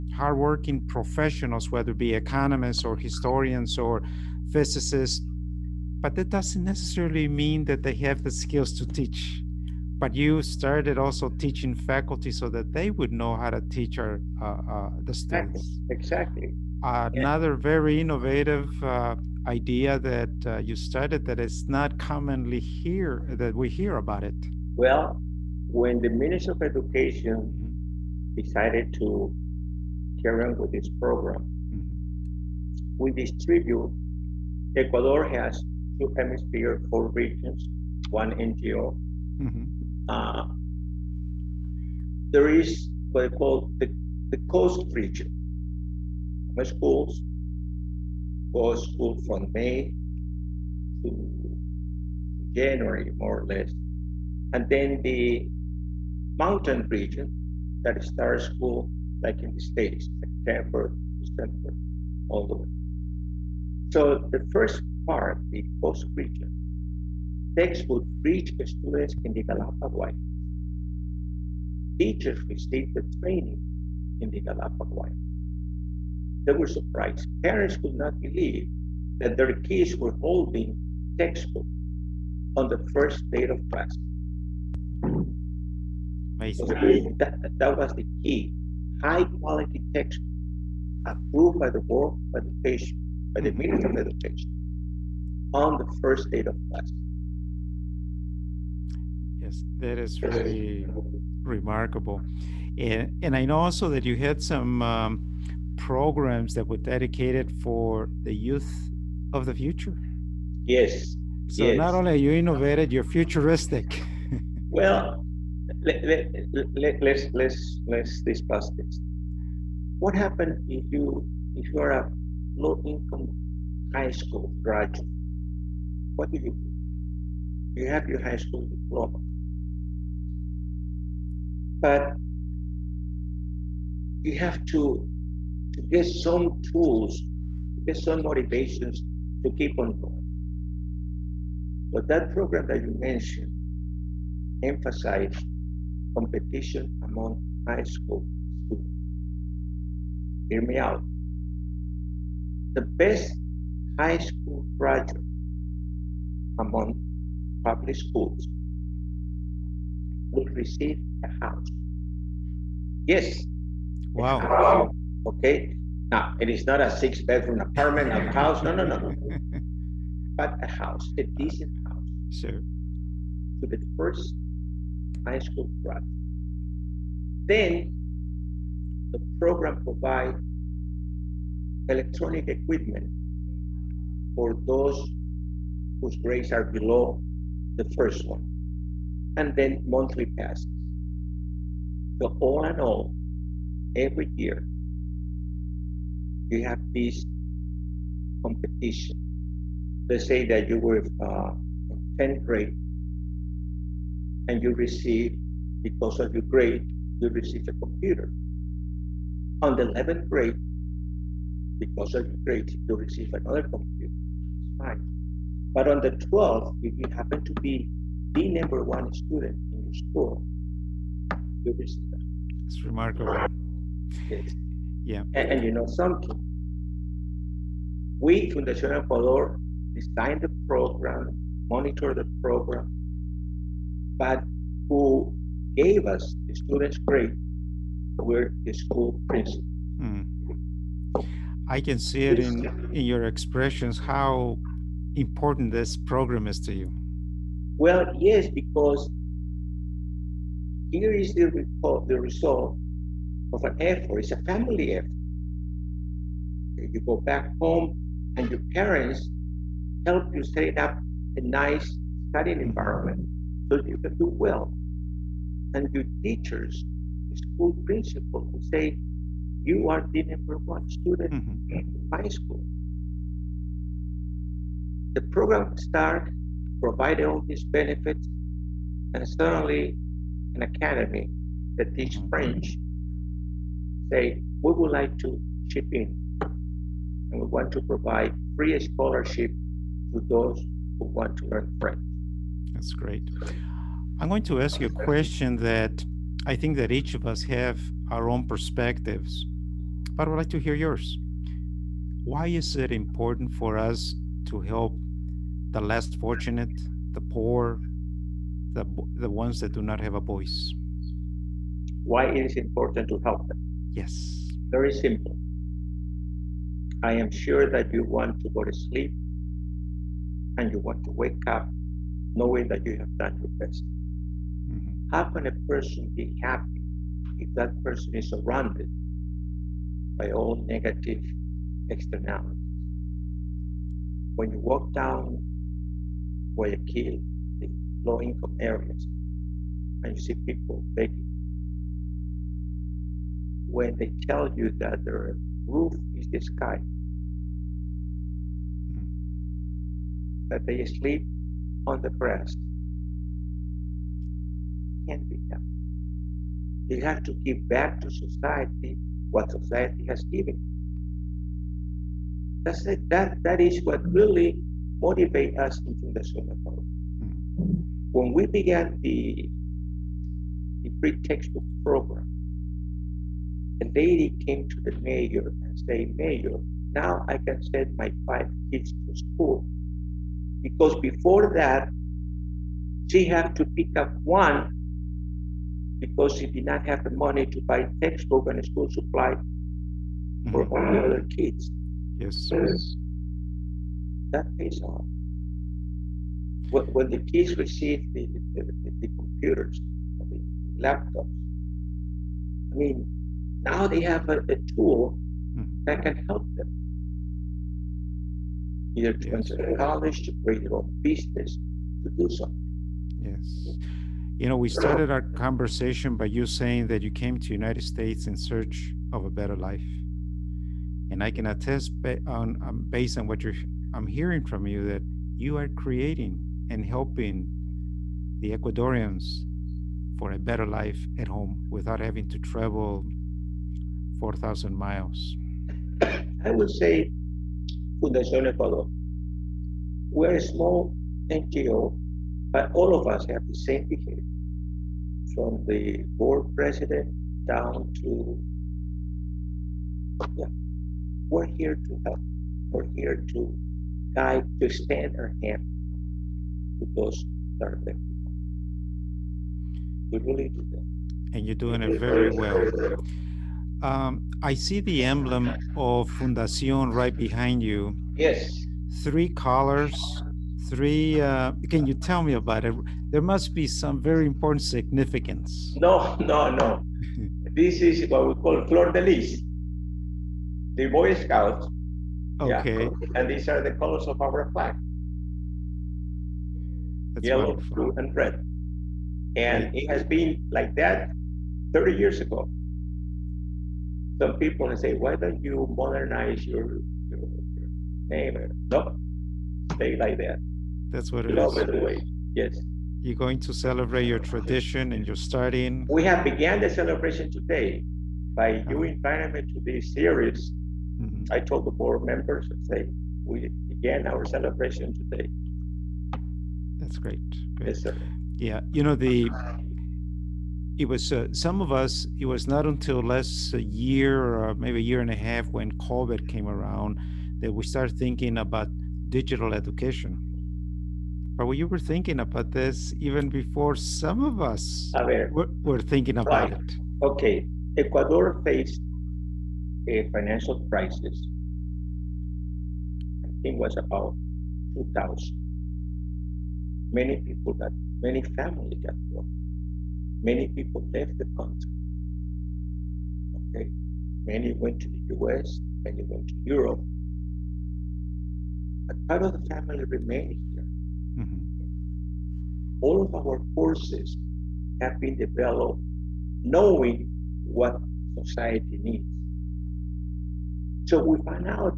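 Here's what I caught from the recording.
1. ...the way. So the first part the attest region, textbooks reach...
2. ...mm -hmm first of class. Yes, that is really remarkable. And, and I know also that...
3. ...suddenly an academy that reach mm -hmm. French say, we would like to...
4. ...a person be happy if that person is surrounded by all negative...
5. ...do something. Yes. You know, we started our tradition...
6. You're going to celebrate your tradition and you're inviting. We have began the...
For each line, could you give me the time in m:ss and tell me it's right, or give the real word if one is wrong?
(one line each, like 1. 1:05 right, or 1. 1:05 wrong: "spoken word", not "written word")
1. 1:02 wrong: "coast", not "attest"
2. 1:33 right
3. 4:39 wrong: "teach", not "reach"
4. 5:25 right
5. 6:52 wrong: "conversation", not "tradition"
6. 8:23 wrong: "starting", not "inviting".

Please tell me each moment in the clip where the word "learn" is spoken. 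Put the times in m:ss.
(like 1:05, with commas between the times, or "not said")
4:51.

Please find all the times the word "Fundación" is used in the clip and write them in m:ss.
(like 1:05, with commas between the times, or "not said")
3:48, 7:18, 7:46.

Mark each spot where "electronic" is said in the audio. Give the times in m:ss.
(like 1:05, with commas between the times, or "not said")
3:01.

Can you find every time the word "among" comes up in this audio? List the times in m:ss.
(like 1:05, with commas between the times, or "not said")
2:27, 2:36.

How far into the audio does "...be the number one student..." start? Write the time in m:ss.
3:37.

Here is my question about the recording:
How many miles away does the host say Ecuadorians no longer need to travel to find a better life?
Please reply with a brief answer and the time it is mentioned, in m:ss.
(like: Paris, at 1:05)
4,000, at 7:14.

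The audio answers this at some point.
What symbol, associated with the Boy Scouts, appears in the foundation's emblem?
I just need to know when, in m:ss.
7:58.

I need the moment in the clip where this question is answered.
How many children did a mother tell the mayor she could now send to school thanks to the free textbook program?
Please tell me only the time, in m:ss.
6:18.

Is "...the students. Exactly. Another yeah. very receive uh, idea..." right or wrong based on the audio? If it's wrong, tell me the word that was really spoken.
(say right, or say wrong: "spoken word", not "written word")
wrong: "innovative", not "receive".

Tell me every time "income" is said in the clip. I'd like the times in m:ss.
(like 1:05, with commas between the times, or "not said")
2:02, 5:38.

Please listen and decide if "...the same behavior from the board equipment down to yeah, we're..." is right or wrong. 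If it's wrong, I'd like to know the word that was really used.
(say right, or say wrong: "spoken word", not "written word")
wrong: "president", not "equipment".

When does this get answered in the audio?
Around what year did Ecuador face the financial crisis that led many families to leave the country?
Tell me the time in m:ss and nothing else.
9:04.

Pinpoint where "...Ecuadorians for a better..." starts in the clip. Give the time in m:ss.
7:08.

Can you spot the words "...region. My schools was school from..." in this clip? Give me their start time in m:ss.
0:44.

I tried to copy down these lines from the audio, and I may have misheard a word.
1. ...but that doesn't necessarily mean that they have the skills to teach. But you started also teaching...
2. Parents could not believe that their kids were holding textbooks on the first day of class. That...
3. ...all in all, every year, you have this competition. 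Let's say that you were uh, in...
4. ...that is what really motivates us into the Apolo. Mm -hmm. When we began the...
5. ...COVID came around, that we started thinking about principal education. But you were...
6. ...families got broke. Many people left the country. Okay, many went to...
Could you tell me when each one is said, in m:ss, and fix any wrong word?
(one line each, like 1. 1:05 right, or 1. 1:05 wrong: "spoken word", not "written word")
1. 0:06 right
2. 1:17 right
3. 3:12 right
4. 6:03 right
5. 8:45 wrong: "digital", not "principal"
6. 9:08 right.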